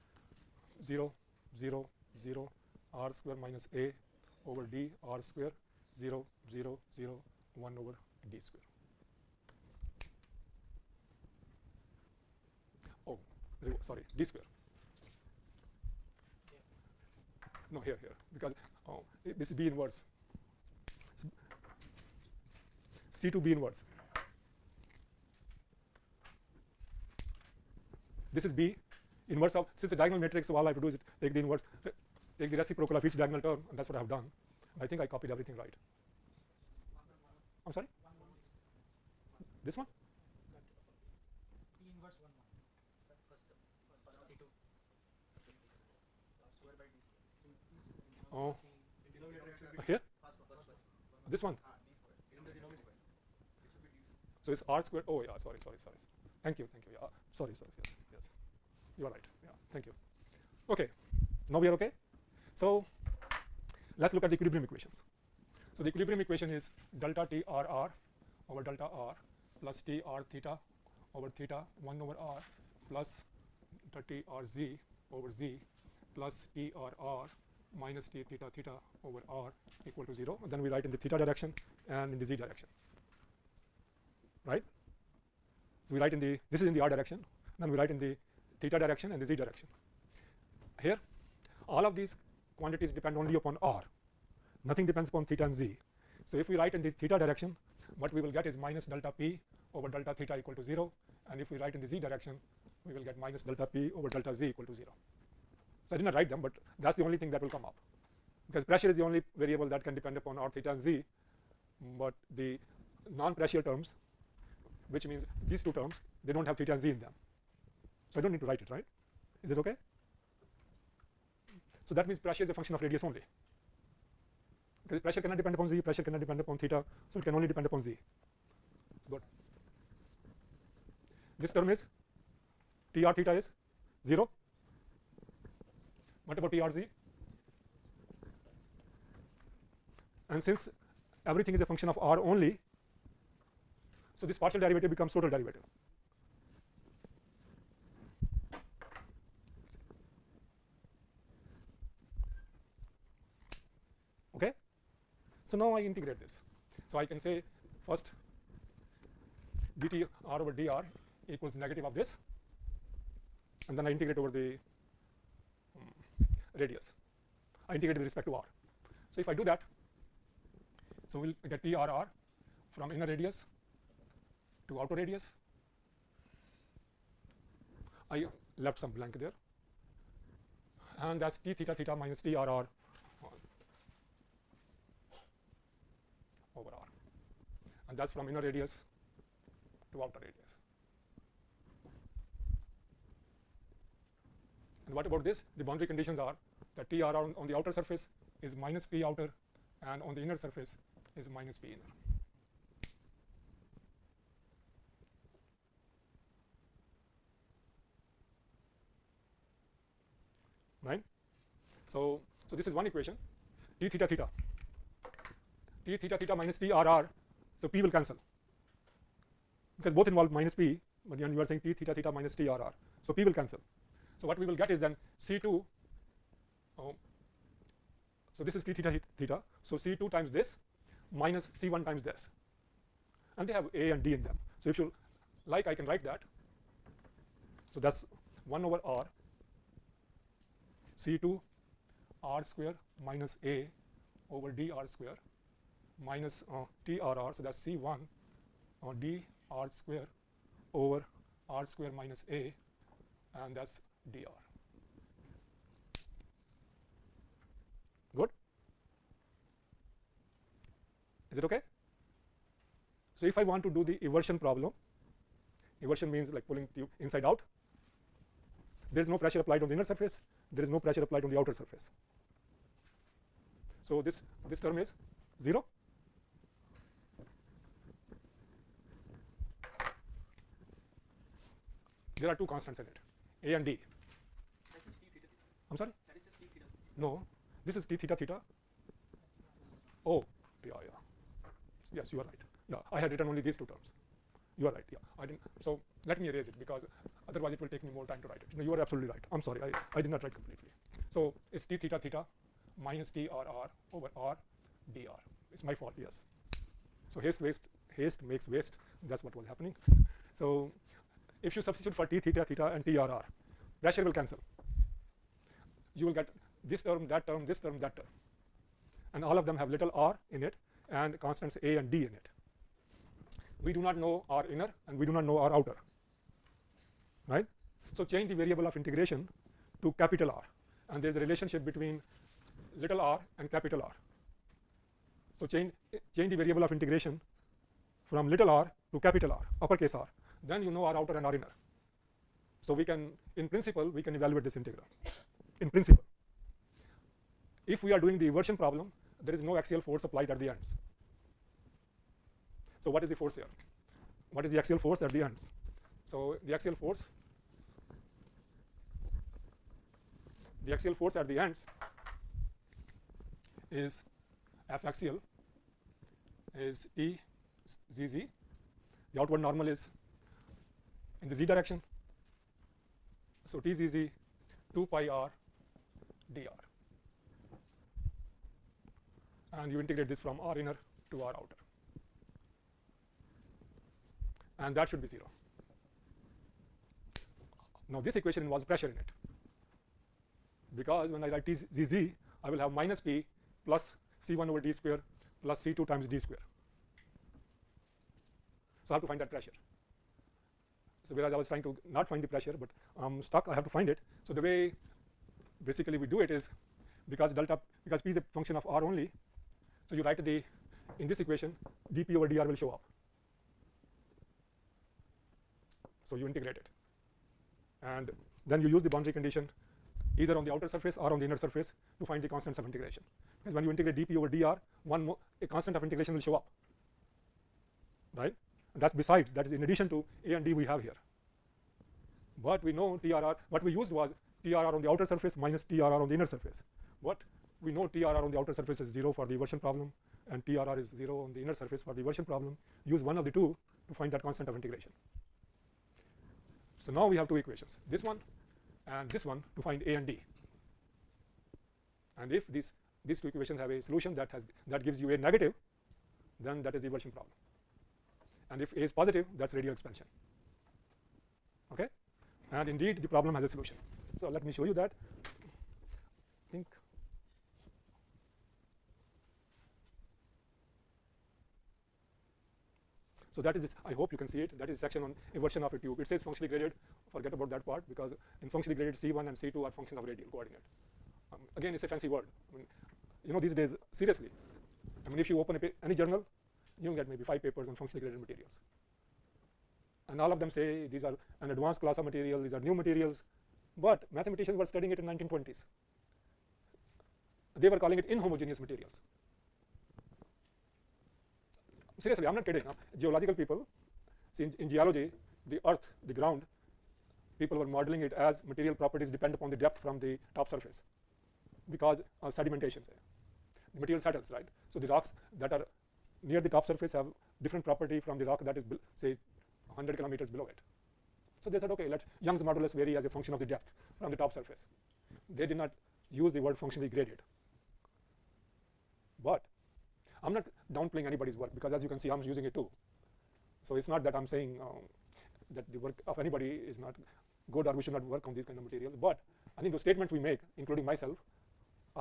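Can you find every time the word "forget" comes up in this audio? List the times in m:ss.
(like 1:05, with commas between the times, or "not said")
7:57.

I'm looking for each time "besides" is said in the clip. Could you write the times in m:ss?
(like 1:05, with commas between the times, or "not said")
7:08.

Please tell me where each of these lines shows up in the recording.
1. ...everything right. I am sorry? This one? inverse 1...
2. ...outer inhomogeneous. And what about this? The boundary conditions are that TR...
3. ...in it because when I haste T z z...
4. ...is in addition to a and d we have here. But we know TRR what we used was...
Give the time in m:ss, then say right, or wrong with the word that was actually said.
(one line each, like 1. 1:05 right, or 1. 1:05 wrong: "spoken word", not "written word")
1. 0:35 right
2. 3:10 wrong: "radius", not "inhomogeneous"
3. 6:28 wrong: "write", not "haste"
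4. 7:09 right.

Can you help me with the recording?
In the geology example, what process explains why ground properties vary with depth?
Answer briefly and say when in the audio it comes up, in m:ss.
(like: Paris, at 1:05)
sedimentation, at 8:32.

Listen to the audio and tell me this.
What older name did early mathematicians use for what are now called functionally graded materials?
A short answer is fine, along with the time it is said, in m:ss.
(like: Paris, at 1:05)
inhomogeneous materials, at 8:18.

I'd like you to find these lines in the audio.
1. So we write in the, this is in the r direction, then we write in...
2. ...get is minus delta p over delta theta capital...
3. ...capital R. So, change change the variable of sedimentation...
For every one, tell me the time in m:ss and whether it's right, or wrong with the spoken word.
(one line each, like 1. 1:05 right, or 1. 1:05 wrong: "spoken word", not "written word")
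1. 1:25 right
2. 1:38 wrong: "equal", not "capital"
3. 5:33 wrong: "integration", not "sedimentation".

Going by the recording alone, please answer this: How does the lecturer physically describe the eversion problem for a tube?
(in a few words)
pulling tube inside out.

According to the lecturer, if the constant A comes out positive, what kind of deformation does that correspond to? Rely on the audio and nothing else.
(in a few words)
radial expansion.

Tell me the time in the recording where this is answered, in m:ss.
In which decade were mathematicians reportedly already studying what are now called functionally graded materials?
8:15.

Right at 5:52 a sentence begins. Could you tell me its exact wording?
So, what is the force here?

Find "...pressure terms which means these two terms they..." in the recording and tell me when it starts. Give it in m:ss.
1:53.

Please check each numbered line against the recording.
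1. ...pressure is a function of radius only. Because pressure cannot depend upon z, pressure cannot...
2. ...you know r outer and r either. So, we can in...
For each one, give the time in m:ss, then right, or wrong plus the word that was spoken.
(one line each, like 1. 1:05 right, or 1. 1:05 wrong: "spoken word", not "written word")
1. 2:02 right
2. 5:40 wrong: "inner", not "either".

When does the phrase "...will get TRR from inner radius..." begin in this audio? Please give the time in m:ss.
2:51.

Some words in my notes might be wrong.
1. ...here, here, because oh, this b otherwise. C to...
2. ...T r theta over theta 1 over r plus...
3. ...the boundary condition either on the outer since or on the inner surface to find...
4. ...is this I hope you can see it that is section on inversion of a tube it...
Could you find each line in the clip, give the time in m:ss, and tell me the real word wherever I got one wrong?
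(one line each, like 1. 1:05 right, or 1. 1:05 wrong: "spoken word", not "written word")
1. 0:17 wrong: "inverse", not "otherwise"
2. 1:09 right
3. 6:58 wrong: "surface", not "since"
4. 7:53 right.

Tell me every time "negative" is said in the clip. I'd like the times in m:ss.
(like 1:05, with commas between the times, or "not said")
2:41, 7:35.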